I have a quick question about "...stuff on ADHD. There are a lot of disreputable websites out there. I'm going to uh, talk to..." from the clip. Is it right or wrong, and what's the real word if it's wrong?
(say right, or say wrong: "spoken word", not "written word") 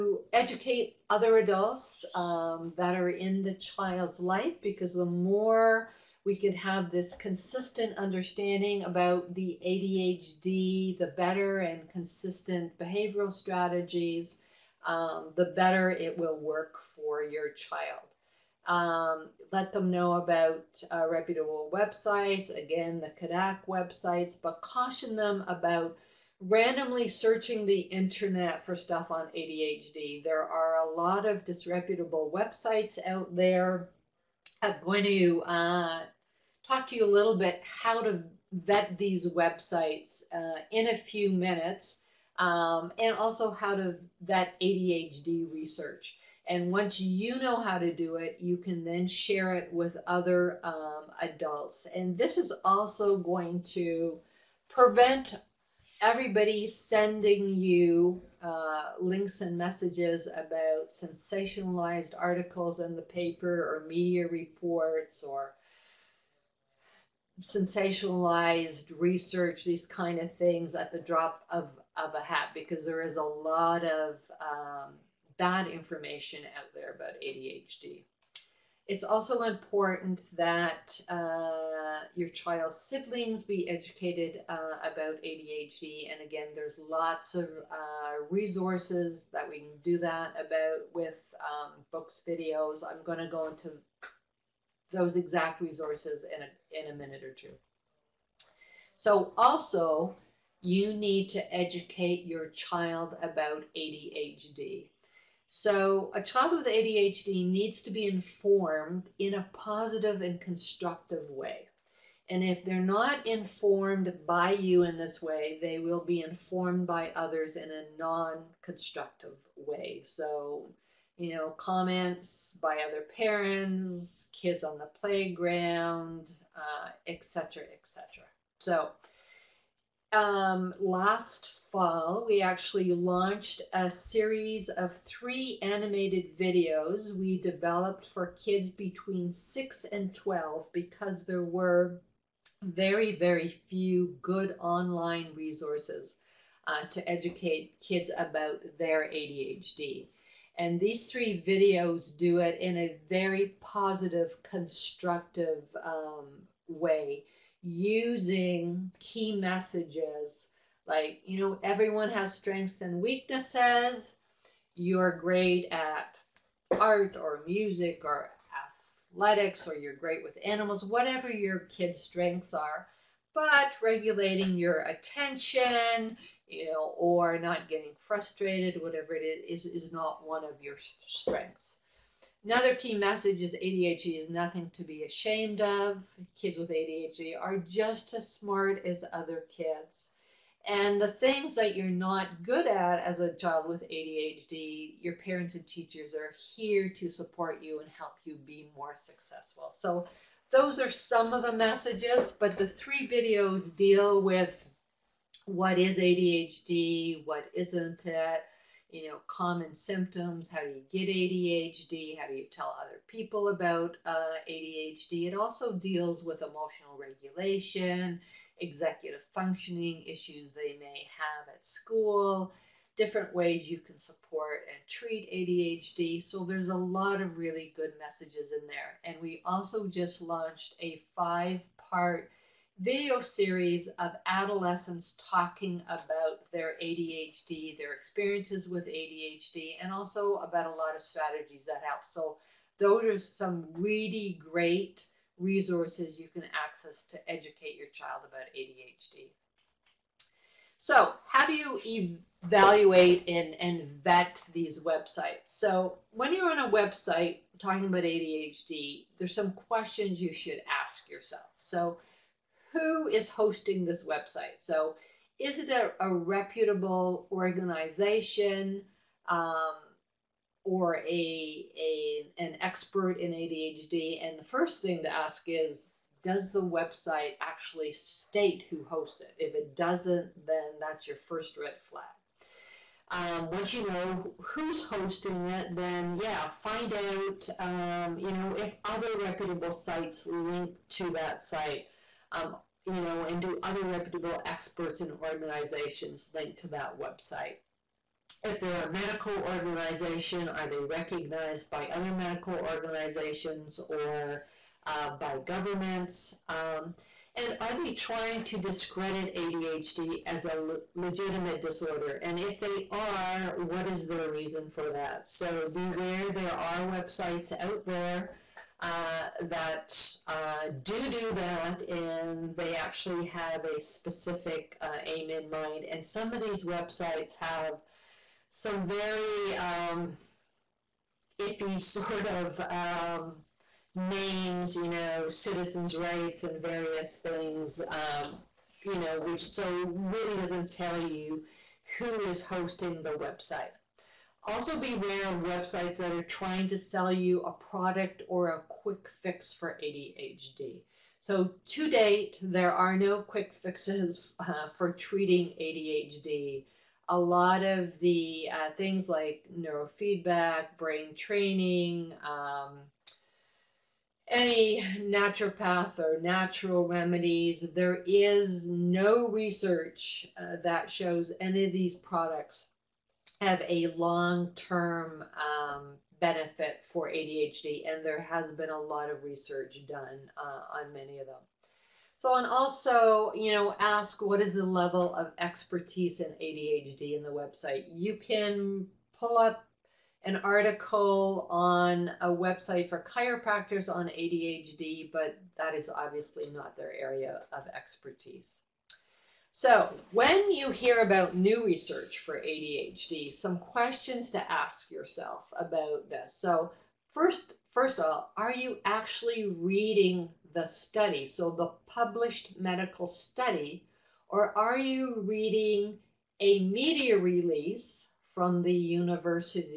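right.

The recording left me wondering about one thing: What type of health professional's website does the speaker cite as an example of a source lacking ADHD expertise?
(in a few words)
chiropractors.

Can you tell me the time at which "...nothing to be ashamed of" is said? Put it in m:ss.
3:04.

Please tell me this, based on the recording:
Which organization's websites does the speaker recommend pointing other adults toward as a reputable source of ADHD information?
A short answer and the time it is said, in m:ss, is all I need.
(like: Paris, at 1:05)
CADDAC, at 0:23.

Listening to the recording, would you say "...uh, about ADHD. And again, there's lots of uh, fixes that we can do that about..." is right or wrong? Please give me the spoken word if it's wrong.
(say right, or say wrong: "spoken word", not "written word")
wrong: "resources", not "fixes".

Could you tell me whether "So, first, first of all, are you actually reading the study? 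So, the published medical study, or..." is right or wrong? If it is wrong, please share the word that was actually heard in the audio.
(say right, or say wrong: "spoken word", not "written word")
right.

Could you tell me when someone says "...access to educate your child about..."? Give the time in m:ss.
4:06.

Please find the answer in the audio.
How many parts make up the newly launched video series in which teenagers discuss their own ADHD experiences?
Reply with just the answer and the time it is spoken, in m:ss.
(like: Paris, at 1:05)
5, at 3:51.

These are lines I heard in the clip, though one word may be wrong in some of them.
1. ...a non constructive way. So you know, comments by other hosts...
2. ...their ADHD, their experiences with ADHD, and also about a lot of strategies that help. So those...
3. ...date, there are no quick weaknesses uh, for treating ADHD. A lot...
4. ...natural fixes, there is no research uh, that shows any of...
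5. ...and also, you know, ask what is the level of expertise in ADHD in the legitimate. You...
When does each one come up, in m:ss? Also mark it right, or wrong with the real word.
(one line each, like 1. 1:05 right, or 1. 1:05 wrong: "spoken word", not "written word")
1. 1:57 wrong: "parents", not "hosts"
2. 3:56 right
3. 5:51 wrong: "fixes", not "weaknesses"
4. 6:06 wrong: "remedies", not "fixes"
5. 6:22 wrong: "website", not "legitimate".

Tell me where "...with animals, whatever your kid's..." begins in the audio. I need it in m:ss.
2:50.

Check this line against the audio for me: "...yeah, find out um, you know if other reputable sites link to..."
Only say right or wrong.
right.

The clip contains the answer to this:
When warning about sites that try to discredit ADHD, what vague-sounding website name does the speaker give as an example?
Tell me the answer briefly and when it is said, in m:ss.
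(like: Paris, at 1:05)
citizens' rights, at 5:35.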